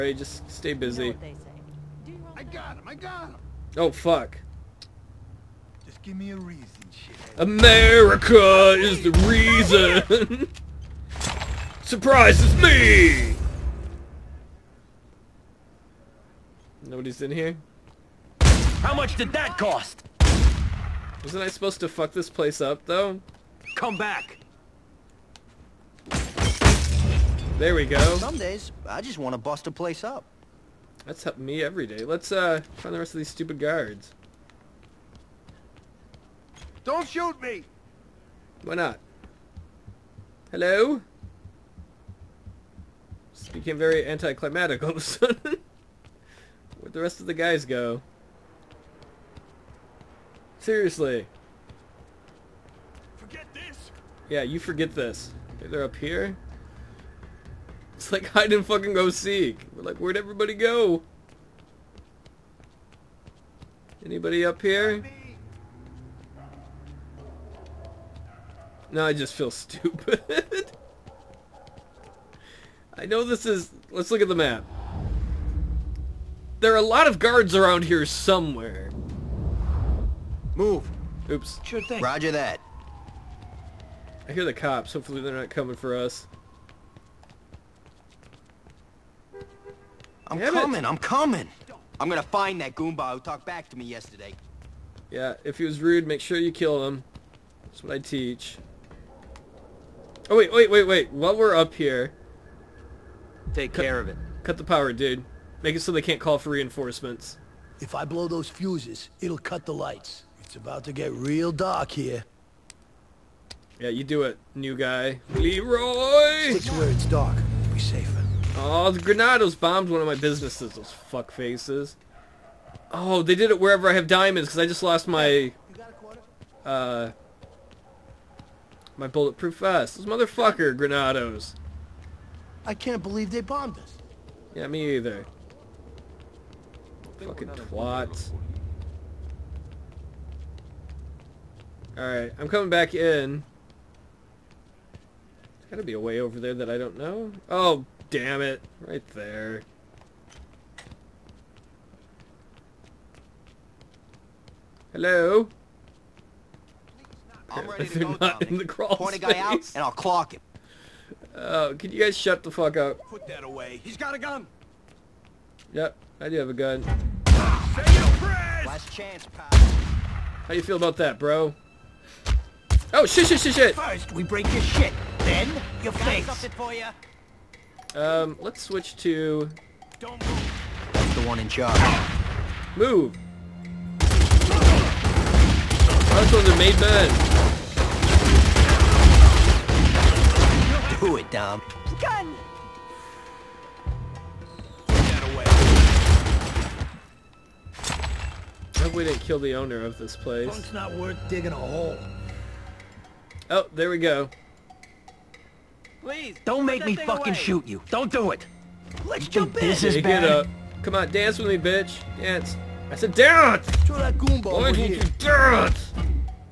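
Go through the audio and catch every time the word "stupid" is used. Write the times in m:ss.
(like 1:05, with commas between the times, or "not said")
0:33, 1:09.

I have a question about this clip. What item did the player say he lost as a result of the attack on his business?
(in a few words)
bulletproof vest.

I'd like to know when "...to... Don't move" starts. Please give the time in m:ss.
2:58.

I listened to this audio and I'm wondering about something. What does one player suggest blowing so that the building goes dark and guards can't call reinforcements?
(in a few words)
fuses.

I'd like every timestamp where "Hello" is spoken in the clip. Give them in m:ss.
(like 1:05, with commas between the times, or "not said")
0:40, 2:34.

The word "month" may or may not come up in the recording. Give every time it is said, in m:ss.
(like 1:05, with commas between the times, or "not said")
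not said.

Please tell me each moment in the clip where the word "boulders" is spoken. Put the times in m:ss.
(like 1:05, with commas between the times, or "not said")
not said.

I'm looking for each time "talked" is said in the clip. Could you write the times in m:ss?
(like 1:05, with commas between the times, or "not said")
1:33.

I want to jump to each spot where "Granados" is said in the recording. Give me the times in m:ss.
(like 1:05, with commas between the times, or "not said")
1:59, 2:10.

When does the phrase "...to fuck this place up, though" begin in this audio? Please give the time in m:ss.
0:21.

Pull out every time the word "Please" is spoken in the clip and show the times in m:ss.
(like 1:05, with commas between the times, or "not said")
3:26.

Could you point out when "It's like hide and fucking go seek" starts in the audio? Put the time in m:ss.
0:57.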